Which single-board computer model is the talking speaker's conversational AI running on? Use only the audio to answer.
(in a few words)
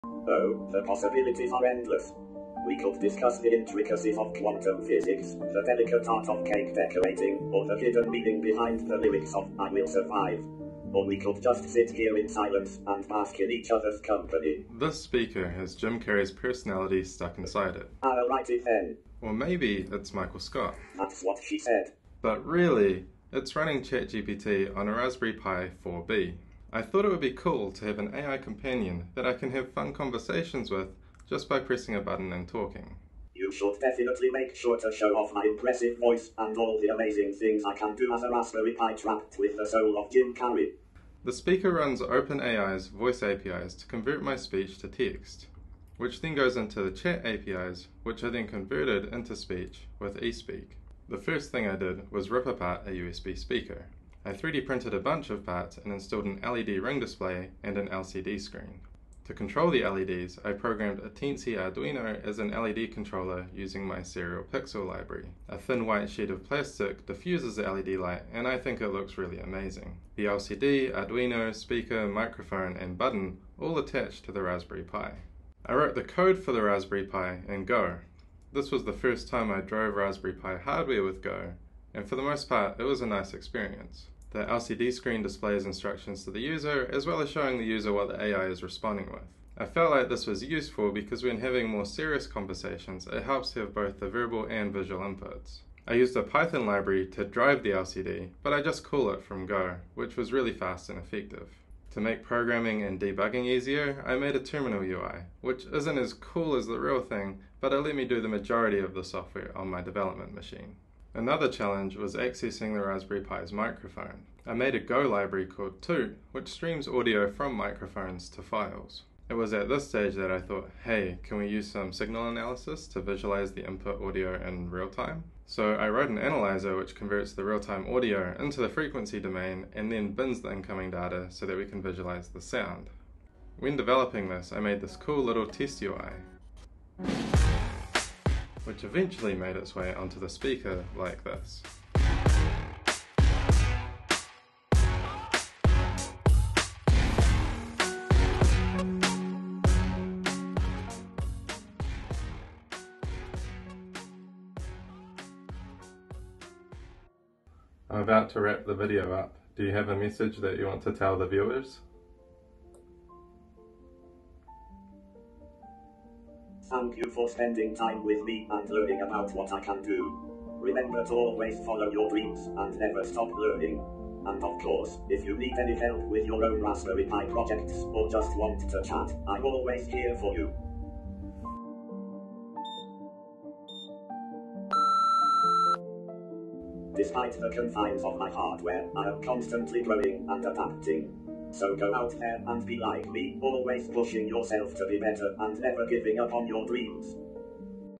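Raspberry Pi 4B.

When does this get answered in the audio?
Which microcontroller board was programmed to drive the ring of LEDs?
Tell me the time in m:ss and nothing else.
1:01.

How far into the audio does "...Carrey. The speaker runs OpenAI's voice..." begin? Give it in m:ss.
0:40.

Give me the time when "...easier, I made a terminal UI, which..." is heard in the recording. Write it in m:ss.
1:43.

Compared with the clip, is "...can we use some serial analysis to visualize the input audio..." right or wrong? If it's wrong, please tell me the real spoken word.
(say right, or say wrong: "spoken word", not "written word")
wrong: "signal", not "serial".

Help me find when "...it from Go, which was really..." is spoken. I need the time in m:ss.
1:39.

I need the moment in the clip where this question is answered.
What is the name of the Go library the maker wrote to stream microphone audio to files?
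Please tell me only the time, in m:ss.
1:55.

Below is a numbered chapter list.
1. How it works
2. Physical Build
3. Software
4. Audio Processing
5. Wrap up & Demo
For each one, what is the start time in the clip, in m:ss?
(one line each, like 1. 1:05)
1. 0:40
2. 0:51
3. 1:15
4. 1:54
5. 2:38.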